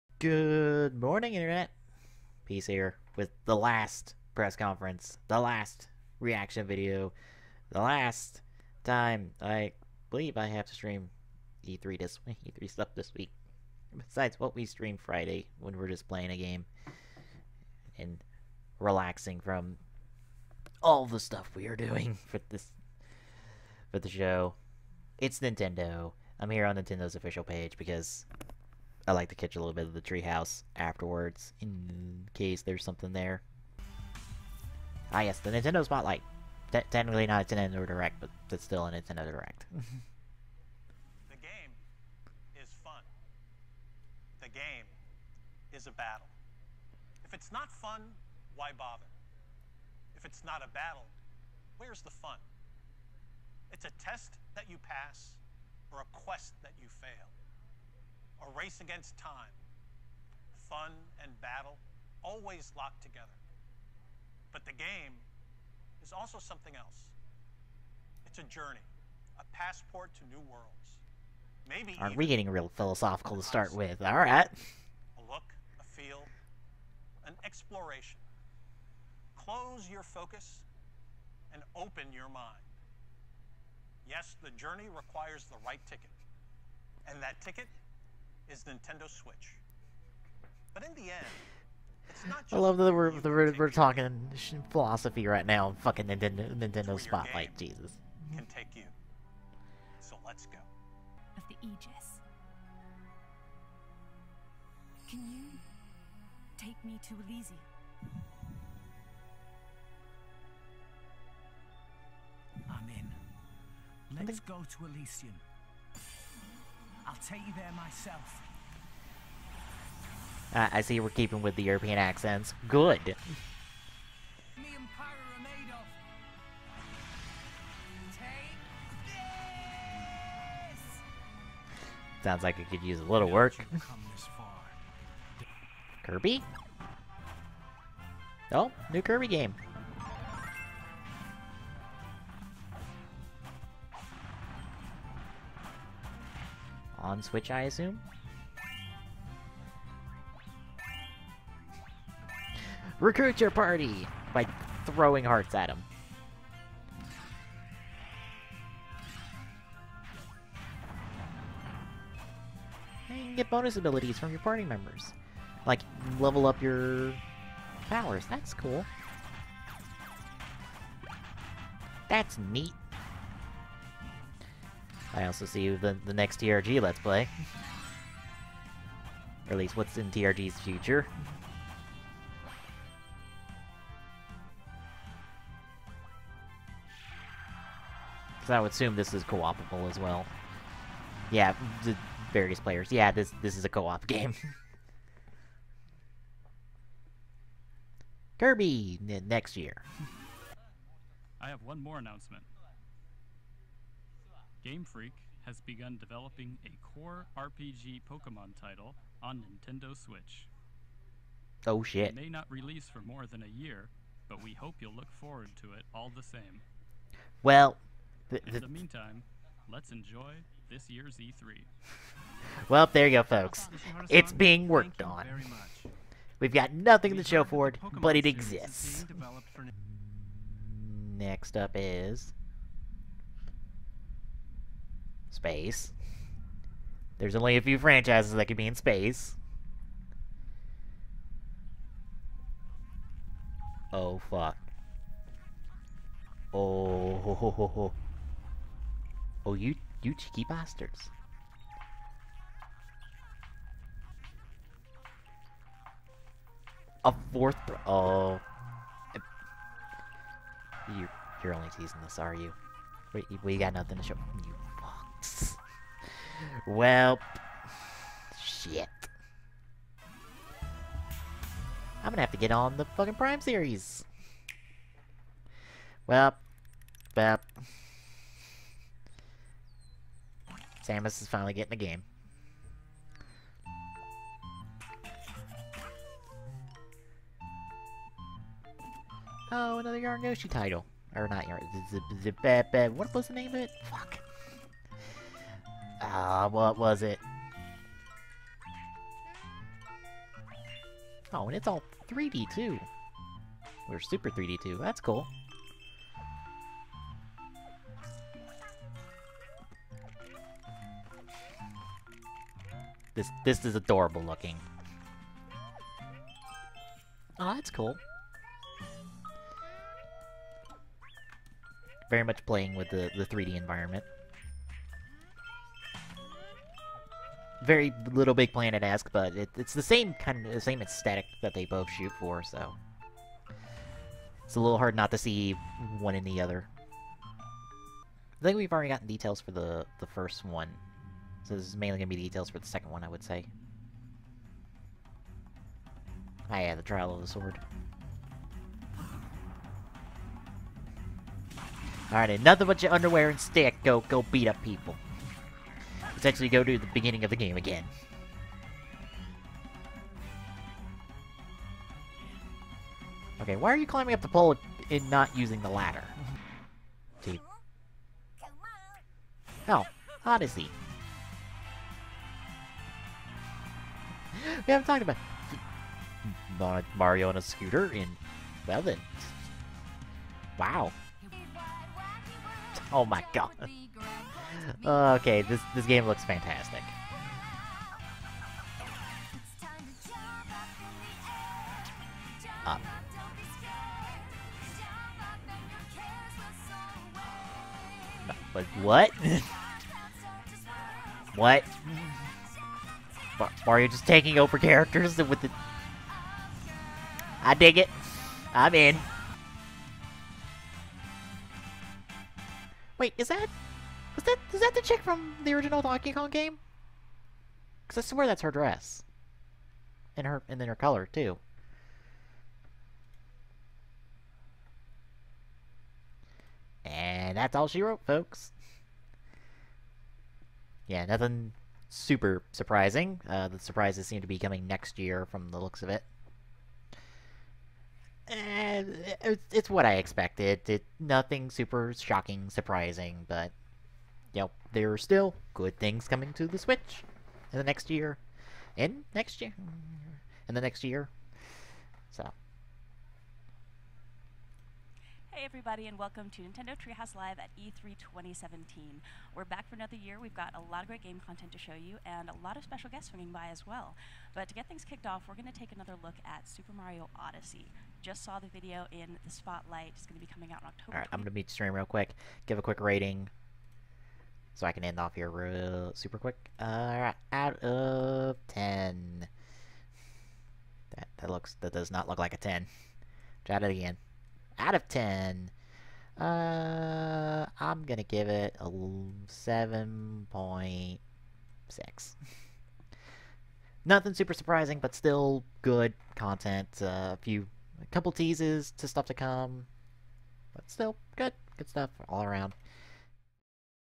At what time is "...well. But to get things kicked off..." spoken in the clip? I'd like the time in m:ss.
7:43.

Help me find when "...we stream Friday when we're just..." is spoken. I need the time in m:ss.
0:14.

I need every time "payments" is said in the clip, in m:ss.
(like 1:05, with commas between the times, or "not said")
not said.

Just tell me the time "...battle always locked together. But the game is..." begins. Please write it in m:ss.
1:01.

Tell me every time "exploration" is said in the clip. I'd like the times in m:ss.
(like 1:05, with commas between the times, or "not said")
1:17.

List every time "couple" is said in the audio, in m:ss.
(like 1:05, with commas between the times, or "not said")
8:17.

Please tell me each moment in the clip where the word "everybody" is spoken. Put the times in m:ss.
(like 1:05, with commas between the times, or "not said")
7:35.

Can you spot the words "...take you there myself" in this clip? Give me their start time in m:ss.
1:57.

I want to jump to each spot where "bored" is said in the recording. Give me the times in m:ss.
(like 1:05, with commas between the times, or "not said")
not said.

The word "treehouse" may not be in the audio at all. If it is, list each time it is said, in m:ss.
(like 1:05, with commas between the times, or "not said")
0:30, 7:36.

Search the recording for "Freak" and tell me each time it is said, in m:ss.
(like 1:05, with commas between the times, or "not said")
3:24.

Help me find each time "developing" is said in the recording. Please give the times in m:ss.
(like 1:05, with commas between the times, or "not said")
3:25.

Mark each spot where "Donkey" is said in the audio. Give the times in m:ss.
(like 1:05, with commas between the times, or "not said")
6:55.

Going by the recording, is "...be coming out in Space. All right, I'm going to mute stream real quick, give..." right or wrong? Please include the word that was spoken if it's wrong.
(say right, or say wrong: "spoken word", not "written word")
wrong: "October", not "Space".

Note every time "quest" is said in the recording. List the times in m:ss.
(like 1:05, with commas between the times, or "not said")
0:56.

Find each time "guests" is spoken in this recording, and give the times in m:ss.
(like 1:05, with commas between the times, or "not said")
7:42.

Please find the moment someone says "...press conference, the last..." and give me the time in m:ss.
0:04.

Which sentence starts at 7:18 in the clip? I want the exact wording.
And uh, it's, it's what I expected.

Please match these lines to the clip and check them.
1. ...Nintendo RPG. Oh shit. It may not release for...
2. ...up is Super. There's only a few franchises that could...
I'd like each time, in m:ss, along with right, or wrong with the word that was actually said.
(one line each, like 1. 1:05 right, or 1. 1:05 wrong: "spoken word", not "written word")
1. 3:29 wrong: "Switch", not "RPG"
2. 3:51 wrong: "Space", not "Super".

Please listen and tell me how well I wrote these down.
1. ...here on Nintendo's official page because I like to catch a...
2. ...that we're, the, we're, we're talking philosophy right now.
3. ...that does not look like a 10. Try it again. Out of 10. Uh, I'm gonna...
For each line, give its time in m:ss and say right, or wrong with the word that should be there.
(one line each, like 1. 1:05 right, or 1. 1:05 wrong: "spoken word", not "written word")
1. 0:26 right
2. 1:32 right
3. 8:01 right.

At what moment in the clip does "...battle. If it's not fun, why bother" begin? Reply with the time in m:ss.
0:45.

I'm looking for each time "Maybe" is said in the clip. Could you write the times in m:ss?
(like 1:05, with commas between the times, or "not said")
1:11.